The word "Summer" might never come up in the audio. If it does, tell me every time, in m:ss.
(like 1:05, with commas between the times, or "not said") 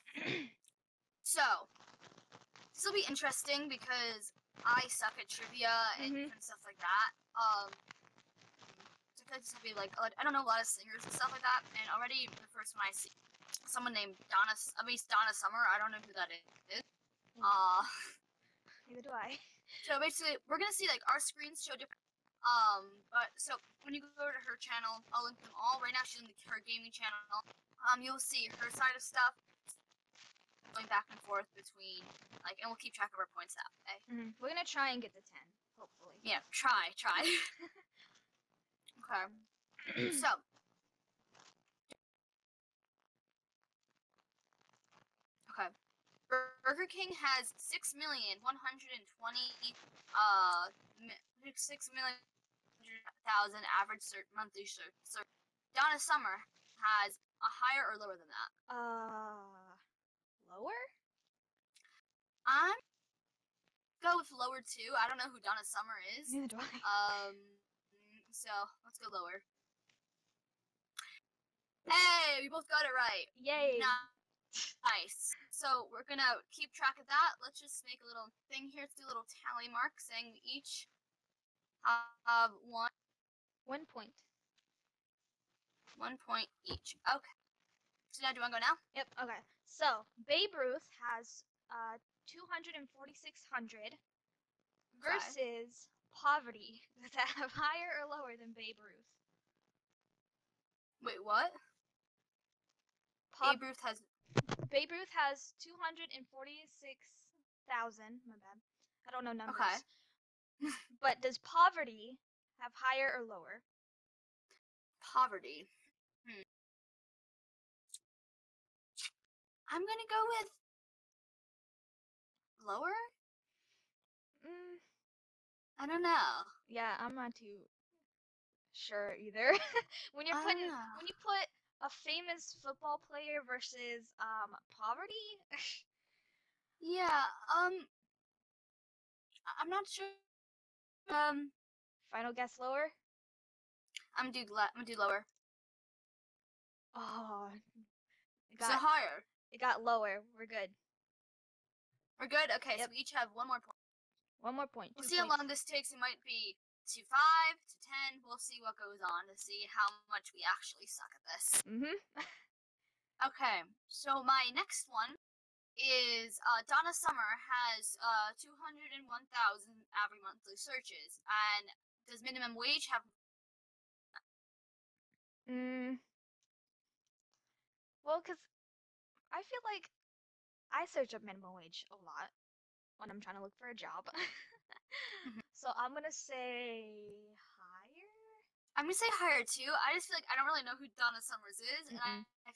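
0:15, 0:55, 1:05, 2:46, 3:11.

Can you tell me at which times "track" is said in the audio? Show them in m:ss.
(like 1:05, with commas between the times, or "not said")
0:32, 1:16.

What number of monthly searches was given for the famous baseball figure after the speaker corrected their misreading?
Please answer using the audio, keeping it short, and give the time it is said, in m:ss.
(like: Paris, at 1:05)
246,000, at 1:45.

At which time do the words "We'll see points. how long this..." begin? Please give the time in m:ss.
2:34.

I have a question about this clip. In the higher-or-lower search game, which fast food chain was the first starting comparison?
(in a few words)
Burger King.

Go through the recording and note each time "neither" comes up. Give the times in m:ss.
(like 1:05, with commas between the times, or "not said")
0:18, 1:06.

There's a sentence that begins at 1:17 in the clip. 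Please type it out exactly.
Let's just make a little thing here.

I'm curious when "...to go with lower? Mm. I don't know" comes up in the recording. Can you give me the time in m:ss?
1:59.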